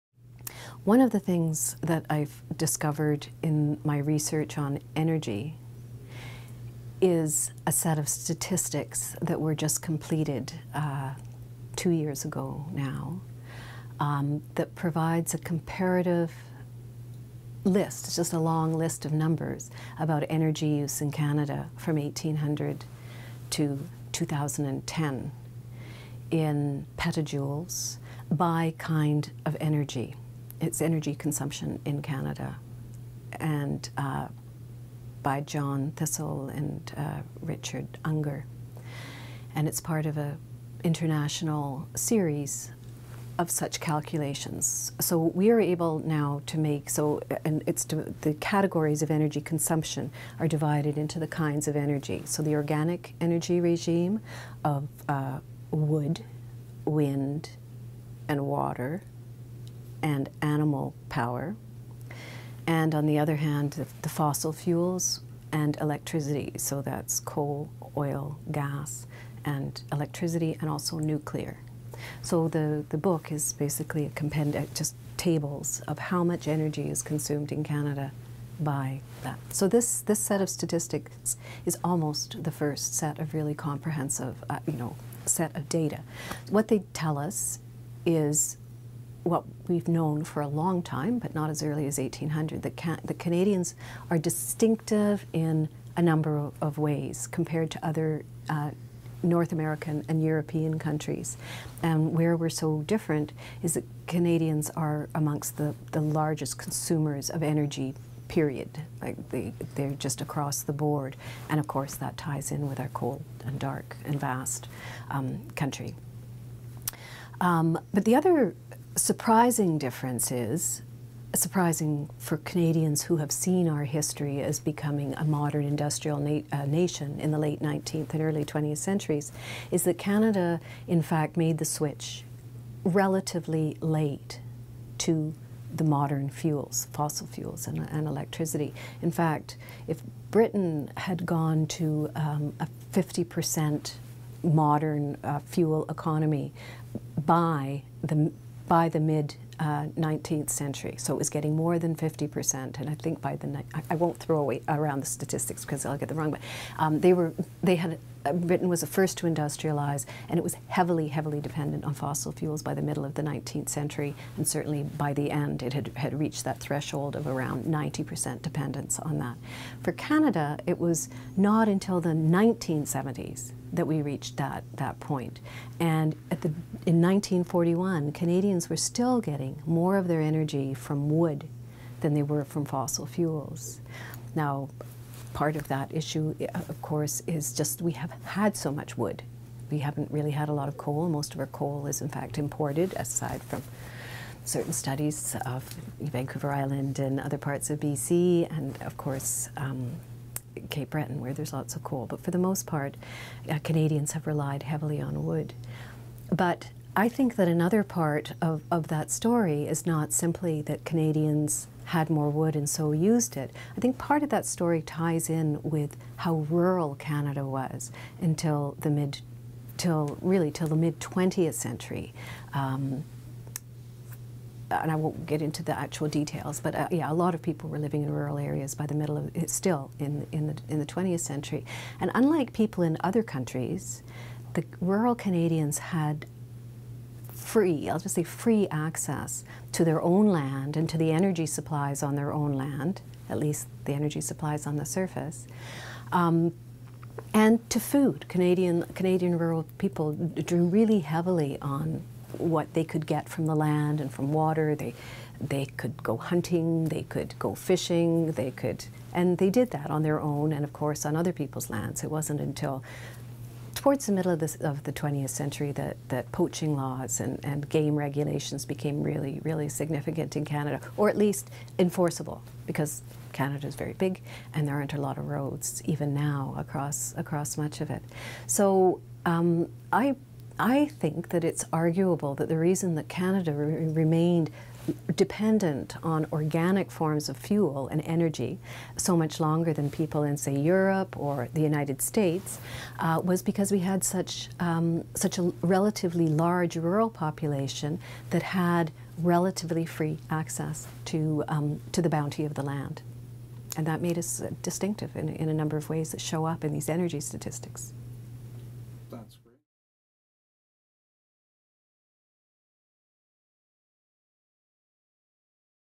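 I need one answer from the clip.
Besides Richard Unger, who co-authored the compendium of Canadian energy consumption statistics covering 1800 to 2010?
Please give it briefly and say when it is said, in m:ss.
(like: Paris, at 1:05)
John Thistle, at 0:35.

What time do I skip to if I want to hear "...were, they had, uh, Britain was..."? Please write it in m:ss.
2:37.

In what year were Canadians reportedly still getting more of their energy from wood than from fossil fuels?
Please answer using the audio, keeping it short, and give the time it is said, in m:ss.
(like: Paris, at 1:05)
1941, at 2:57.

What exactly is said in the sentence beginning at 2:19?
In fact, if Britain had gone to um, a 50% modern uh, fuel economy by the by the mid uh, 19th century.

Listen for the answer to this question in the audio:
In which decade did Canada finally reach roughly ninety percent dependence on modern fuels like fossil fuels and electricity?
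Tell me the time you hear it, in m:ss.
2:52.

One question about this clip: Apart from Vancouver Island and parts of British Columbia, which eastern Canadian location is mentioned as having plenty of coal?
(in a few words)
Cape Breton.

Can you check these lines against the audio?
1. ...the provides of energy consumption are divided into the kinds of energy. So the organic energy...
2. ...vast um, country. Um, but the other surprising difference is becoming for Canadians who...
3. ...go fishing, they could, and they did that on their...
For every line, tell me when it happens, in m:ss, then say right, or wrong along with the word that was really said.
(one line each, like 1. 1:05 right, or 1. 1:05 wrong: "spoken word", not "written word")
1. 0:48 wrong: "categories", not "provides"
2. 1:54 wrong: "surprising", not "becoming"
3. 4:17 right.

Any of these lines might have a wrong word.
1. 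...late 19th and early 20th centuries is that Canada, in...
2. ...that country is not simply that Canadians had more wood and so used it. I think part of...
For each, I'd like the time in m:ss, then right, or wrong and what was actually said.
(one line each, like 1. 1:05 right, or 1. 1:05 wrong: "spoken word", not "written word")
1. 2:07 right
2. 3:28 wrong: "story", not "country".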